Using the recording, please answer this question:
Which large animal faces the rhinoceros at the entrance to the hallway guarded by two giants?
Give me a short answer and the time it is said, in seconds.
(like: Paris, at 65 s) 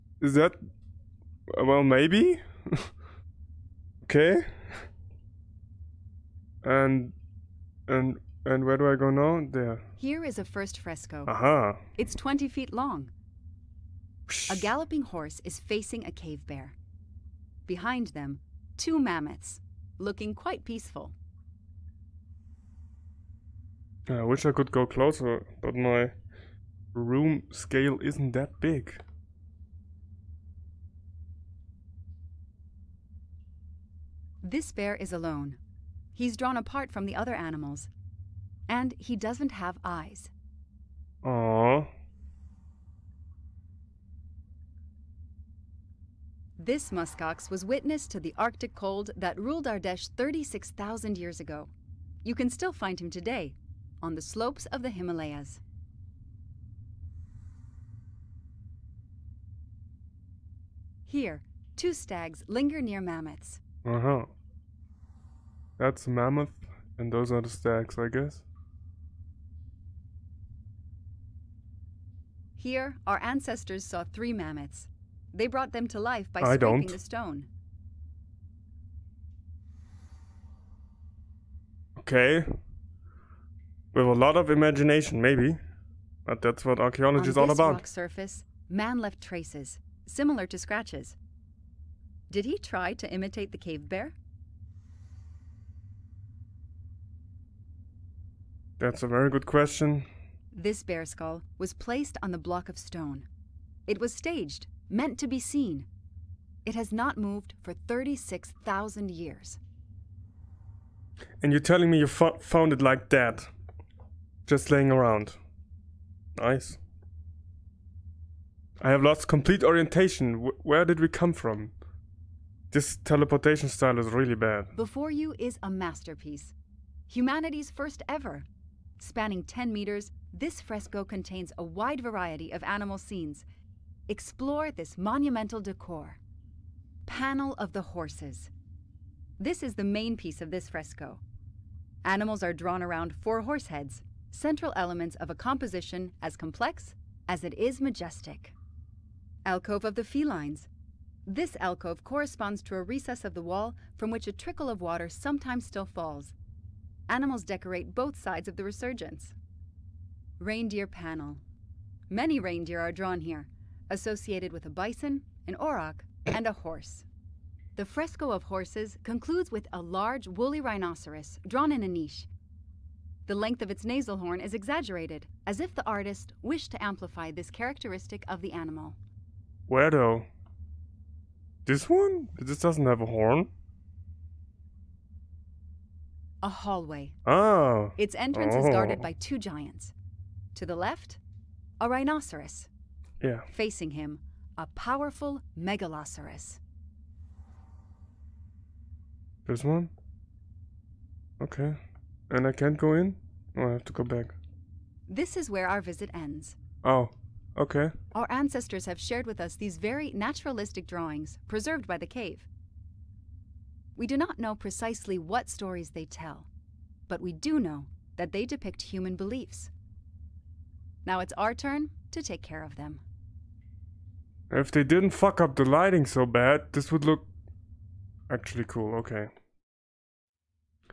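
Megaloceros, at 195 s.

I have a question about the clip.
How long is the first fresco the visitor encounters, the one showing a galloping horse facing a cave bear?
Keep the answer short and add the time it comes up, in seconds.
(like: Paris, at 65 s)
20 feet, at 12 s.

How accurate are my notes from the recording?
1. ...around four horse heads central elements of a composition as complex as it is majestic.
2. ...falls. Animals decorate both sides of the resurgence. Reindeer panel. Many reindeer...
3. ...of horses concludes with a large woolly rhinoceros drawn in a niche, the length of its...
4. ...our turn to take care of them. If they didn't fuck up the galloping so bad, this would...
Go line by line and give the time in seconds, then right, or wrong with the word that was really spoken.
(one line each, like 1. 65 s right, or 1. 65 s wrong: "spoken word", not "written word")
1. 142 s right
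2. 155 s right
3. 168 s right
4. 221 s wrong: "lighting", not "galloping".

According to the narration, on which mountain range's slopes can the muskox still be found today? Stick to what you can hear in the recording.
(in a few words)
Himalayas.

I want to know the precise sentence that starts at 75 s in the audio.
They brought them to life by I don't.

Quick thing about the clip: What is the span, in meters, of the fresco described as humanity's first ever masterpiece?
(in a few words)
10 meters.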